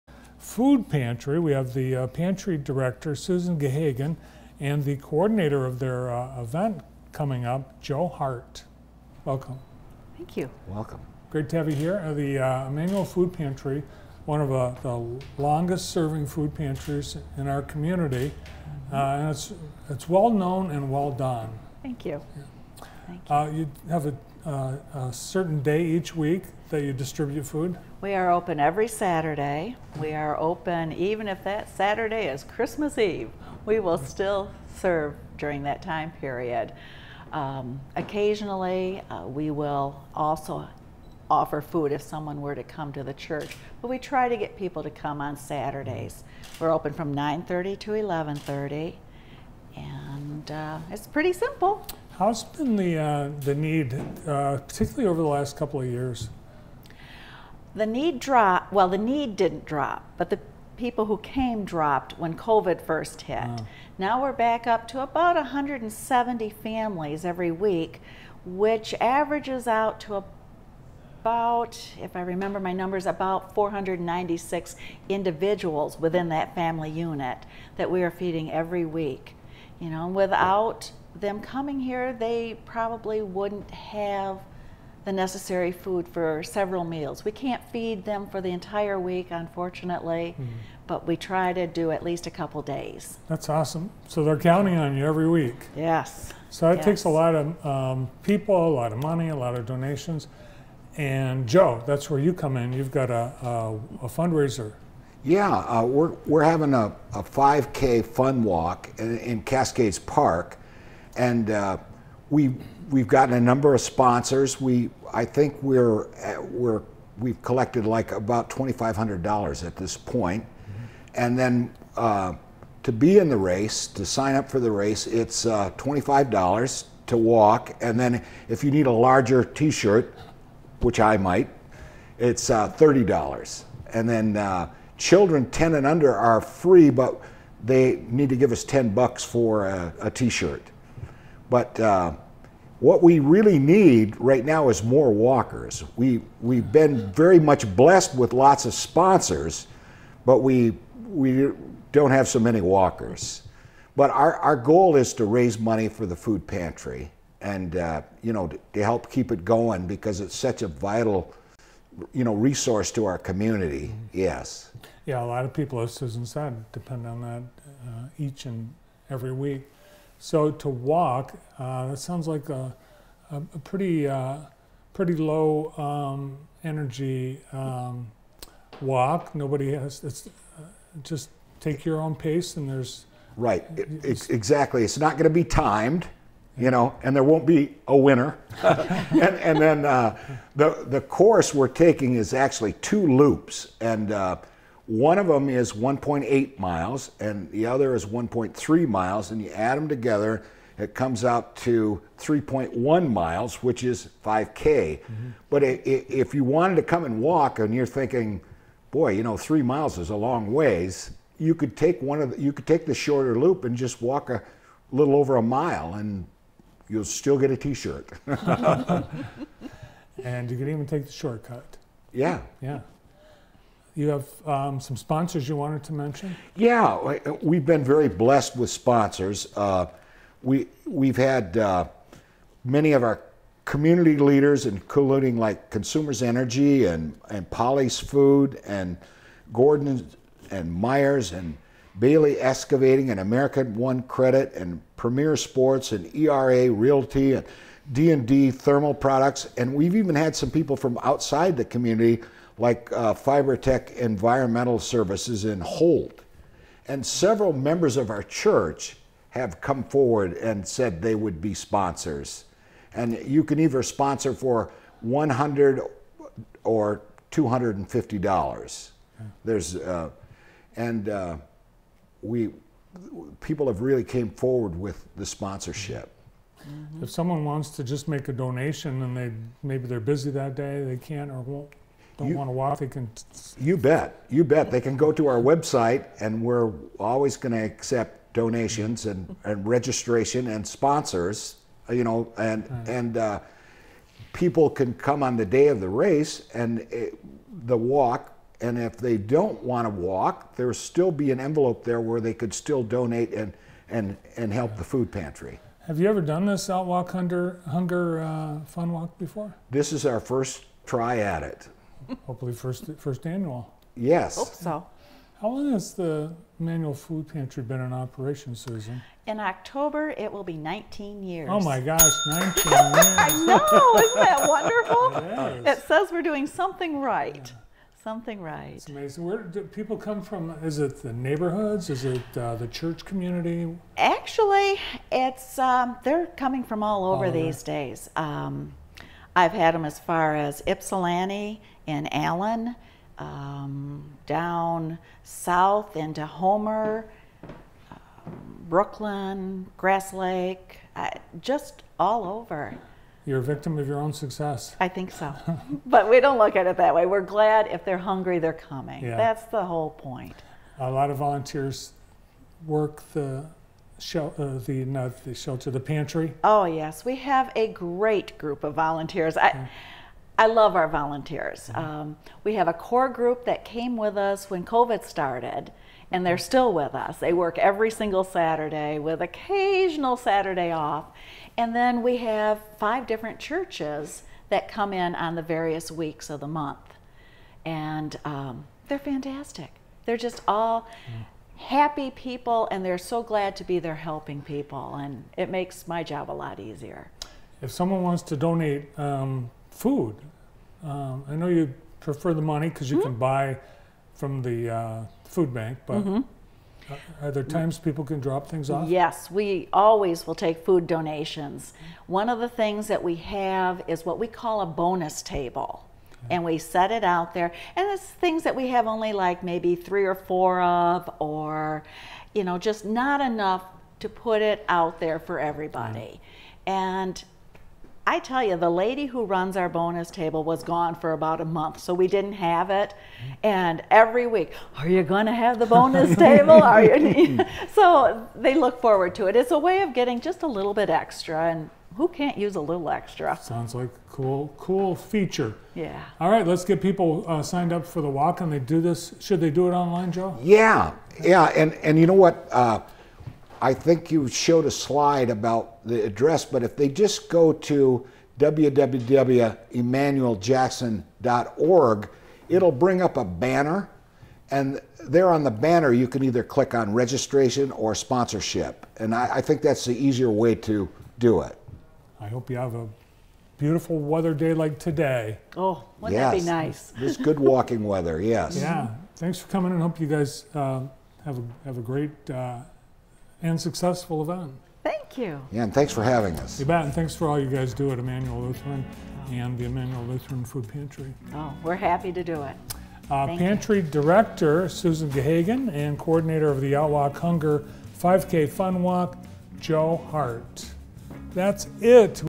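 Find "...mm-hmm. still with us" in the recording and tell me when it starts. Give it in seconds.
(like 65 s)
376 s.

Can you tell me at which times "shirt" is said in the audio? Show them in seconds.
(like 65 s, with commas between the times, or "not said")
129 s, 140 s, 217 s.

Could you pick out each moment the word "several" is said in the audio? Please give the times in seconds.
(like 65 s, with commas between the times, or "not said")
86 s, 257 s.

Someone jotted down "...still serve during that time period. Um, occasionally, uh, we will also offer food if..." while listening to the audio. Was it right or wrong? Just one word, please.
right.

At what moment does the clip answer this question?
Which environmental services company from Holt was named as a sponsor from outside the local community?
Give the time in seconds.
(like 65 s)
253 s.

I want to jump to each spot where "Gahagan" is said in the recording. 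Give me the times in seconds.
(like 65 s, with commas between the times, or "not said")
3 s, 495 s.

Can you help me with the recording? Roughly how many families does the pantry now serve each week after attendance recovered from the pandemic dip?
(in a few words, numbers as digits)
170.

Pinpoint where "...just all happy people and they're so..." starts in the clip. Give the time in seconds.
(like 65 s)
390 s.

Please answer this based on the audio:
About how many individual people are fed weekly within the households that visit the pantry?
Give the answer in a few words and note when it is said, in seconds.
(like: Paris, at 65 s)
496, at 73 s.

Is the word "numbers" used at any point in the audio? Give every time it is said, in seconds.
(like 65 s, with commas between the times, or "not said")
72 s, 113 s.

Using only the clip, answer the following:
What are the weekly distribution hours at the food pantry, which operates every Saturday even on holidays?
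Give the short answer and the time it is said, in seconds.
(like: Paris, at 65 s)
9:30 to 11:30, at 47 s.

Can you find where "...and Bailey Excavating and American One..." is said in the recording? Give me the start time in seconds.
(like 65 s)
241 s.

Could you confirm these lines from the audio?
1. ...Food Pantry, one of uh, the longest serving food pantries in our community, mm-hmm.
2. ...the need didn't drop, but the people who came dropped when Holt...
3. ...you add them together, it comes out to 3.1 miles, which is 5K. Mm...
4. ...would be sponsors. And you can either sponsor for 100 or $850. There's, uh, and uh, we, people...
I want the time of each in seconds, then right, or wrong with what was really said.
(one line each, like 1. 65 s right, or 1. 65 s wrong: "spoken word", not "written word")
1. 13 s right
2. 58 s wrong: "COVID", not "Holt"
3. 199 s right
4. 261 s wrong: "250", not "850".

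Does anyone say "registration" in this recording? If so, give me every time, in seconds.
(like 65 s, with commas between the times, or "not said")
289 s, 466 s.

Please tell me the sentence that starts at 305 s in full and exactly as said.
Have you ever done this Outwalk Hunger, hunger uh, Fun Walk before?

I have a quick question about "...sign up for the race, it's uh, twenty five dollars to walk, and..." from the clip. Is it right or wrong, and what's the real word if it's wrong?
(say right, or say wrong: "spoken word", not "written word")
right.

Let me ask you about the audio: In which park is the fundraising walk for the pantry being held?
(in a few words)
Cascades Park.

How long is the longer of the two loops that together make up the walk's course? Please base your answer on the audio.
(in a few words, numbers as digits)
1.8 miles.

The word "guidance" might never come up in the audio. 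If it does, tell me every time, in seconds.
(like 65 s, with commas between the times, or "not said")
not said.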